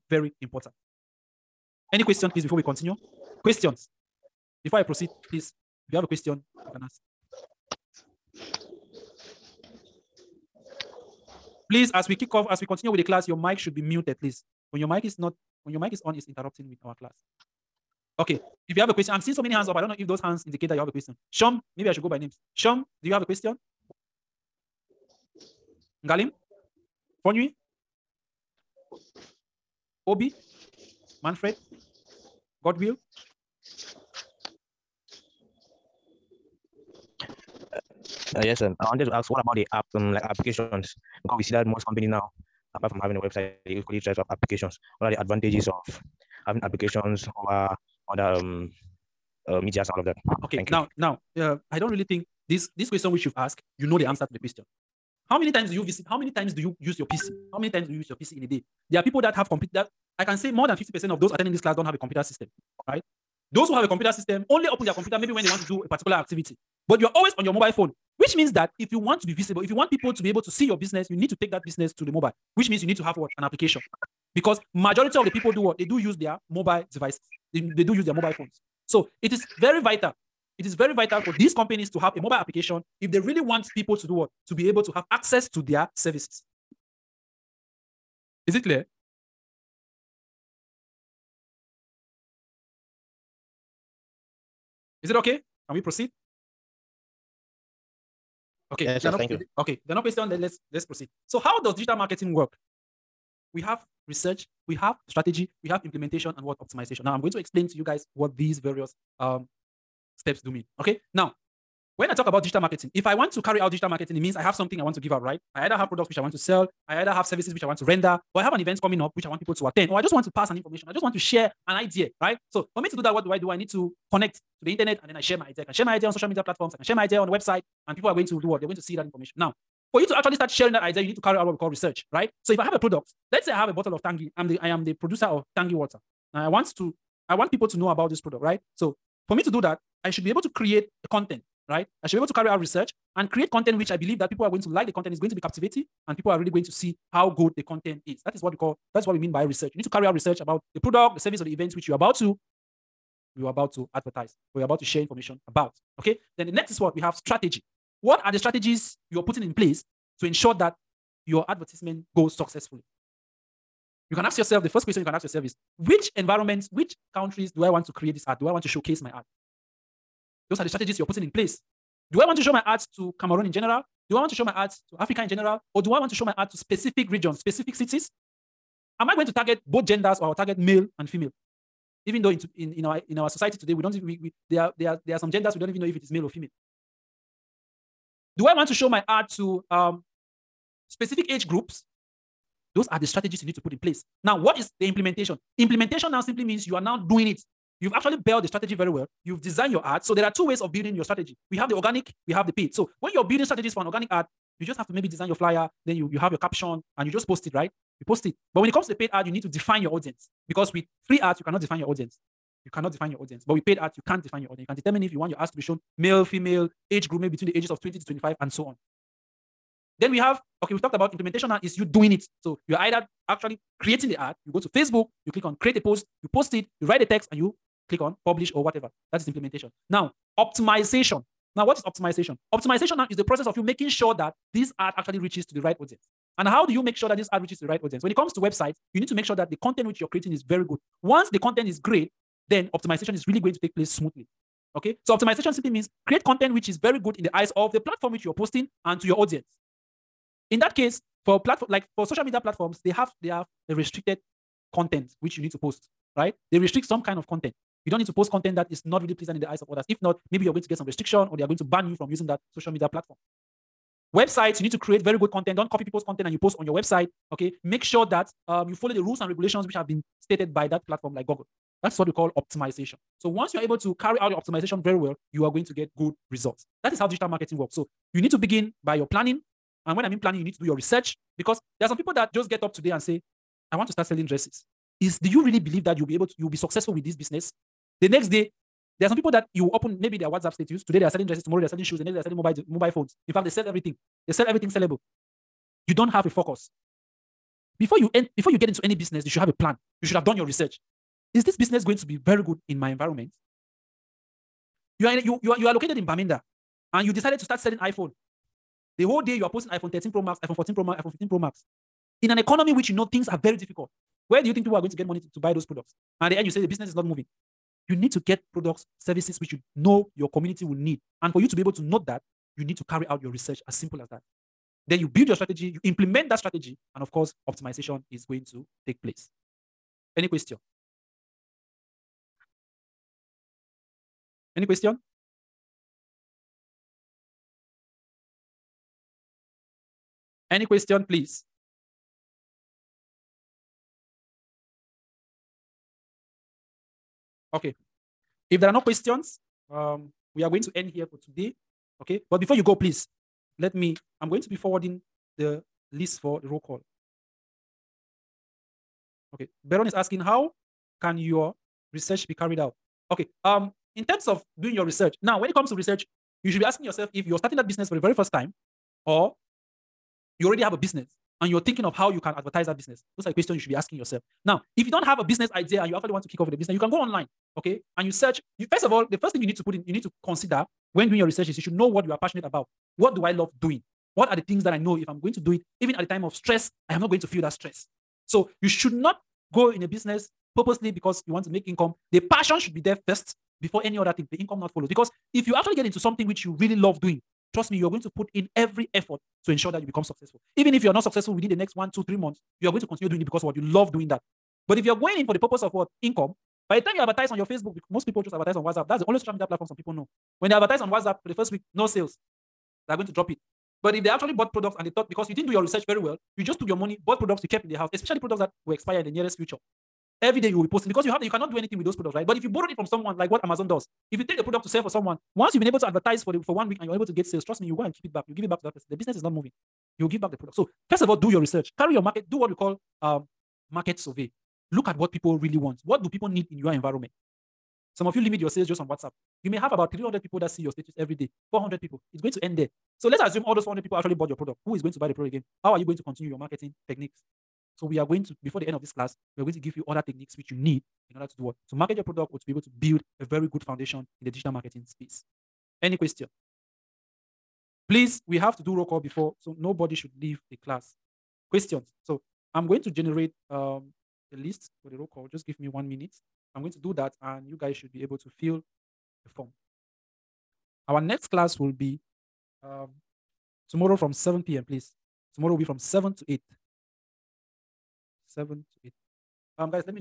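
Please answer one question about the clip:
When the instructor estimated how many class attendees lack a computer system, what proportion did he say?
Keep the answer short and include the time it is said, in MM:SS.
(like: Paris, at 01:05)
more than 50%, at 01:00.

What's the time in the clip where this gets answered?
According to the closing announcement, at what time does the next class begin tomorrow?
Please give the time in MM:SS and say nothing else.
07:54.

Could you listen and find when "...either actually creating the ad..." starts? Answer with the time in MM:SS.
03:42.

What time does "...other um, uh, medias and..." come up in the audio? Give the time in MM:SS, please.
00:48.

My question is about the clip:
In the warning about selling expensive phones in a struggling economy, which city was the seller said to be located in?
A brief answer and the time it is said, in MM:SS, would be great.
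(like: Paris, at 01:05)
Bamenda, at 05:06.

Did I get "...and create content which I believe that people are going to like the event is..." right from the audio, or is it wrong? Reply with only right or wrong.
wrong.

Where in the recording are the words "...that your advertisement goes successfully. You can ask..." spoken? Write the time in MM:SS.
02:40.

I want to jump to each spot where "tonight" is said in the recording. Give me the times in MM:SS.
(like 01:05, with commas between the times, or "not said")
not said.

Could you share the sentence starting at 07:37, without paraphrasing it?
Please, we have to do roll call before, so nobody should leave the class.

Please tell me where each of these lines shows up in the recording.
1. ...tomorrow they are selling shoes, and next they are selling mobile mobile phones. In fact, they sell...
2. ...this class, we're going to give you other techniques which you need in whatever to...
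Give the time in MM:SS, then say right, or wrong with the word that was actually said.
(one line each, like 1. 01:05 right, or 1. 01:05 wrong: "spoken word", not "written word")
1. 04:51 right
2. 07:28 wrong: "order", not "whatever".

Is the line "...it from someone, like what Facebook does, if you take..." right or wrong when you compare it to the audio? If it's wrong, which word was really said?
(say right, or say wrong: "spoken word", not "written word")
wrong: "Amazon", not "Facebook".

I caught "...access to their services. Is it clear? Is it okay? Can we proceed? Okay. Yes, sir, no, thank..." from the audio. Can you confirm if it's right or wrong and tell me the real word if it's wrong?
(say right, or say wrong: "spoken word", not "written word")
right.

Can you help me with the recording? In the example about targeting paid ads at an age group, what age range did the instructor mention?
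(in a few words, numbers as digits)
20 to 25.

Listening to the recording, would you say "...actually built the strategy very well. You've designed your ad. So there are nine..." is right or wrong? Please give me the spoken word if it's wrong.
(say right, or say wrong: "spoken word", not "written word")
wrong: "two", not "nine".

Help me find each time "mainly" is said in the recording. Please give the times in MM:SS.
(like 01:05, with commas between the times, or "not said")
not said.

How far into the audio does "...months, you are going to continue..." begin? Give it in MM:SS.
06:42.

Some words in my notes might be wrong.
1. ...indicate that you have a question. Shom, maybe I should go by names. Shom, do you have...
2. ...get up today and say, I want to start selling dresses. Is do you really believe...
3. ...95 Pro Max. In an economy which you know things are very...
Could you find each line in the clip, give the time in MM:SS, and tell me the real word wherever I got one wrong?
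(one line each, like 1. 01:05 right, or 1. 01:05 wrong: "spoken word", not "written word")
1. 00:20 right
2. 04:42 right
3. 05:11 wrong: "15", not "95".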